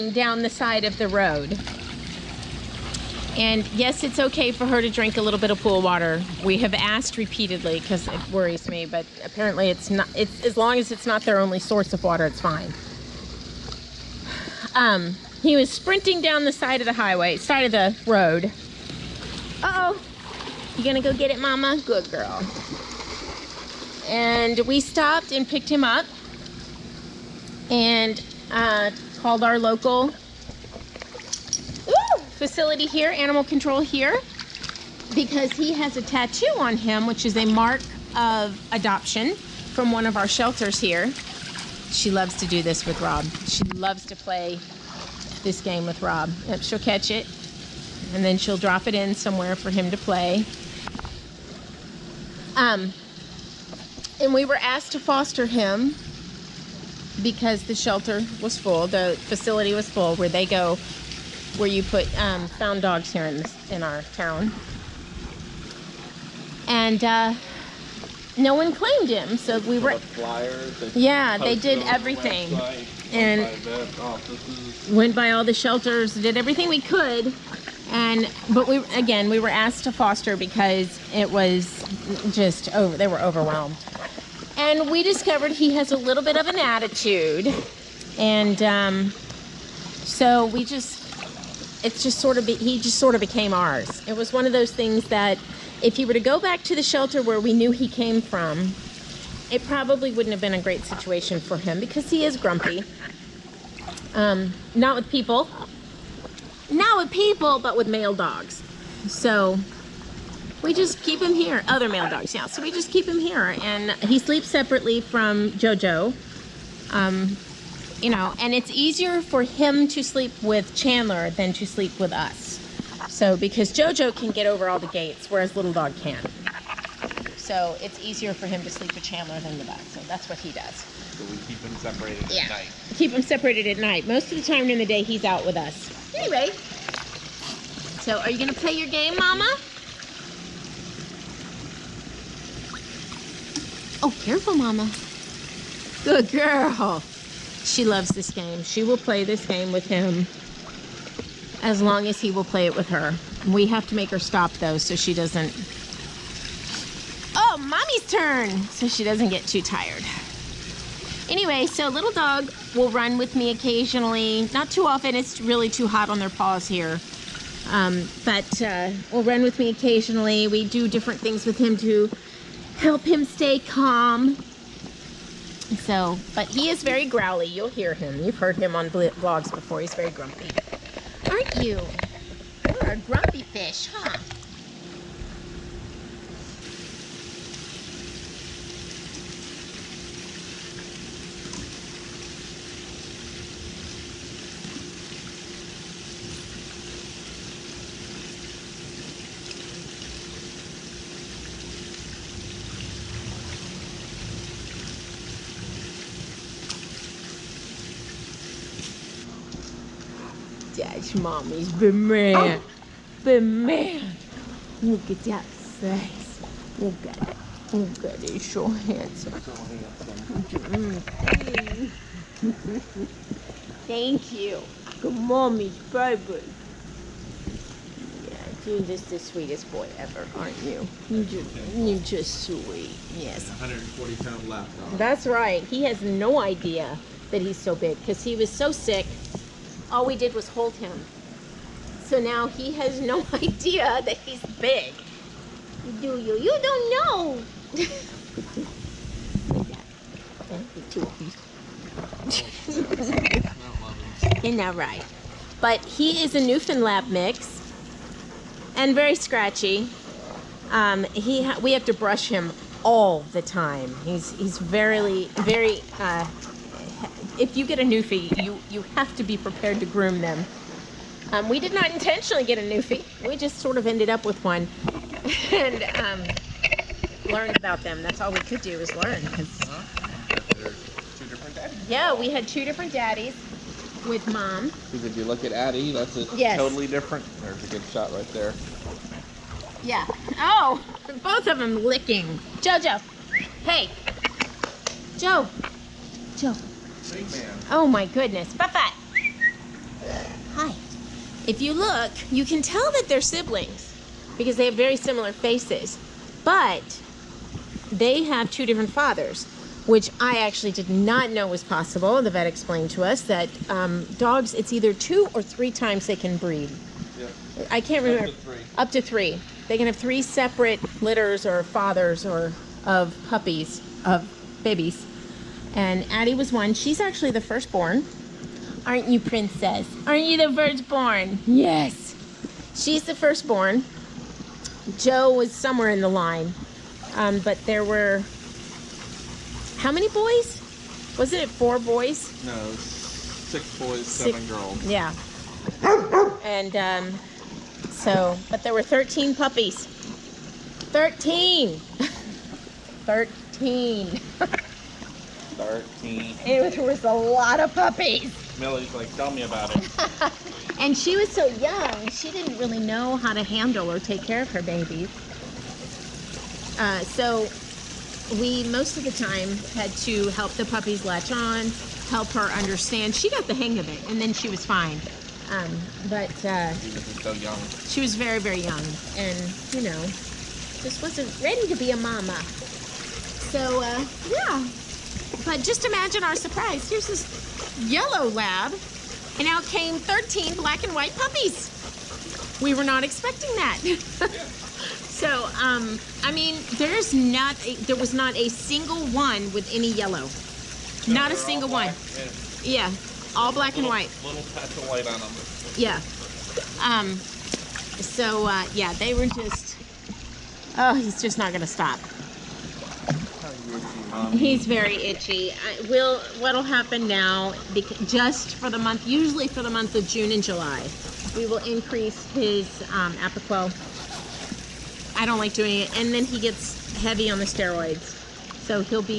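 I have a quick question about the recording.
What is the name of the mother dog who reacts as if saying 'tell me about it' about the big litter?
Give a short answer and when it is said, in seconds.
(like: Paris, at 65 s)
Millie, at 358 s.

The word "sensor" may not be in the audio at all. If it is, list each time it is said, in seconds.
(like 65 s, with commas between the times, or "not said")
not said.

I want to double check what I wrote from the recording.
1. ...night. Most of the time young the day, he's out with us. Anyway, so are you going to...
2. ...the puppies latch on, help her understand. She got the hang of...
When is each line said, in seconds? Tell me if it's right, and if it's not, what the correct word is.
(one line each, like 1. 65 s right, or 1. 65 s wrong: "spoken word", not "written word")
1. 133 s wrong: "during", not "young"
2. 370 s right.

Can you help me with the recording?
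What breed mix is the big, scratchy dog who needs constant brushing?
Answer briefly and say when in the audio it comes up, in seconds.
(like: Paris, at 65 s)
Newfoundland mix, at 256 s.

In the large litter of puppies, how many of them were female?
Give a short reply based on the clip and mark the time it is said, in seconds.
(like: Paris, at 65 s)
7, at 344 s.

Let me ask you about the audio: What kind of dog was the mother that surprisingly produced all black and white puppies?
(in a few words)
yellow lab.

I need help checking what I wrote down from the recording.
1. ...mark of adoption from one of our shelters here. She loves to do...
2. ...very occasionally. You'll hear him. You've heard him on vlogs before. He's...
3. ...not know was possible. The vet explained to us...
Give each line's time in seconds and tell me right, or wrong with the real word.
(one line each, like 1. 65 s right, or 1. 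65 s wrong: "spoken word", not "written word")
1. 37 s right
2. 176 s wrong: "growly", not "occasionally"
3. 310 s right.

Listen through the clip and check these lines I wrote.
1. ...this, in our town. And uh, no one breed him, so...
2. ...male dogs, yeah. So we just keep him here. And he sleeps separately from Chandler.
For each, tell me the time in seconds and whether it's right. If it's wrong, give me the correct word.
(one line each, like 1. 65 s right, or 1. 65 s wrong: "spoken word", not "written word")
1. 63 s wrong: "claimed", not "breed"
2. 111 s wrong: "Jojo", not "Chandler".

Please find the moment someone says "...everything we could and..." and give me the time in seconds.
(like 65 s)
76 s.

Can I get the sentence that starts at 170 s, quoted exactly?
We do different things with him to help him stay calm.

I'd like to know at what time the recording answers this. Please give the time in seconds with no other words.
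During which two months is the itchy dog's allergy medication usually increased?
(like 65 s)
420 s.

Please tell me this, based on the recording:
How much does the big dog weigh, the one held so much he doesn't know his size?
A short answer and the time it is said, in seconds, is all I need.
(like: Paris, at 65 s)
140 pounds, at 233 s.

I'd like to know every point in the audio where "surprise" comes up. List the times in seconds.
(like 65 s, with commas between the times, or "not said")
386 s.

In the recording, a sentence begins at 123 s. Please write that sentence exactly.
So because Jojo can get over all the gates, whereas little dog can't.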